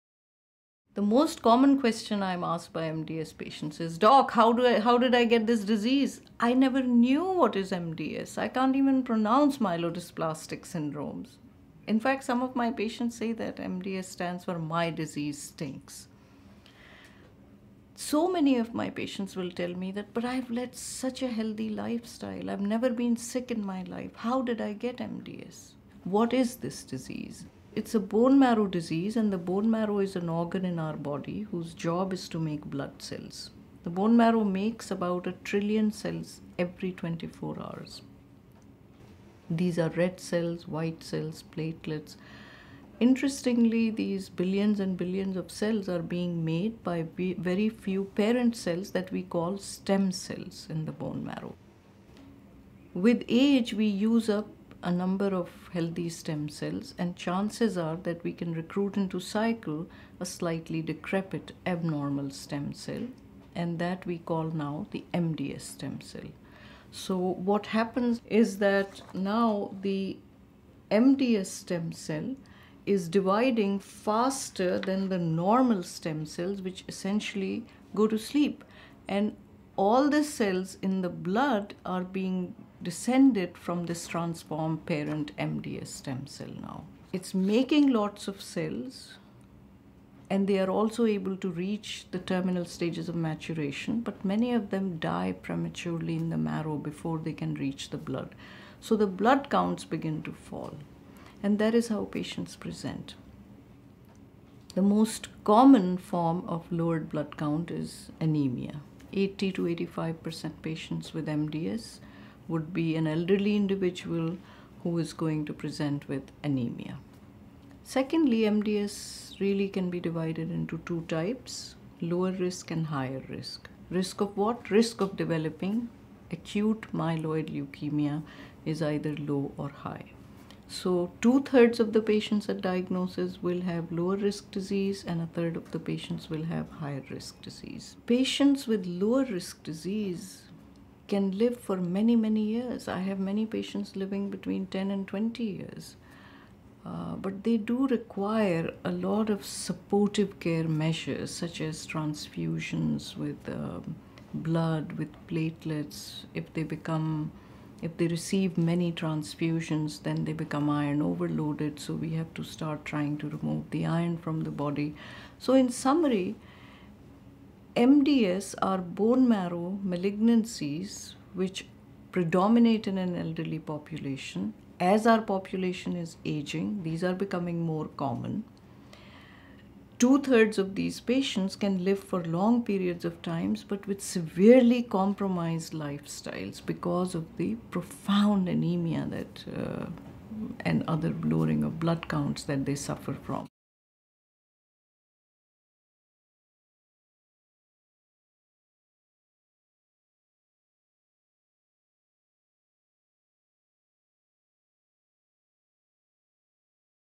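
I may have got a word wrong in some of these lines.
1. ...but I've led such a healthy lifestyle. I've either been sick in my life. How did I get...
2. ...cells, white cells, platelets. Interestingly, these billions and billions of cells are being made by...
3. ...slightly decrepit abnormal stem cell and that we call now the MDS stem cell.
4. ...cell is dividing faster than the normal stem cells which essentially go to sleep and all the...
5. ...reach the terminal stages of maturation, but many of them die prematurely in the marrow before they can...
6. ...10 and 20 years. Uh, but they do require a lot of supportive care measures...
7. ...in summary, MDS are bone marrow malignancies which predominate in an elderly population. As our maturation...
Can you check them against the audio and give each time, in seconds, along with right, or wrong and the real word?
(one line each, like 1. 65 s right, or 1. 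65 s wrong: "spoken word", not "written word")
1. 20 s wrong: "never", not "either"
2. 40 s right
3. 60 s right
4. 71 s right
5. 91 s right
6. 144 s right
7. 165 s wrong: "population", not "maturation".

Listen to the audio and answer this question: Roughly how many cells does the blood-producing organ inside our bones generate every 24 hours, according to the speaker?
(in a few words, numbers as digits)
A trillion.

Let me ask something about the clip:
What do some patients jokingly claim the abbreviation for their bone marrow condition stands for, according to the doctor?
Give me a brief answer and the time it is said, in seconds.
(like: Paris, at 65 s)
My disease stinks, at 14 s.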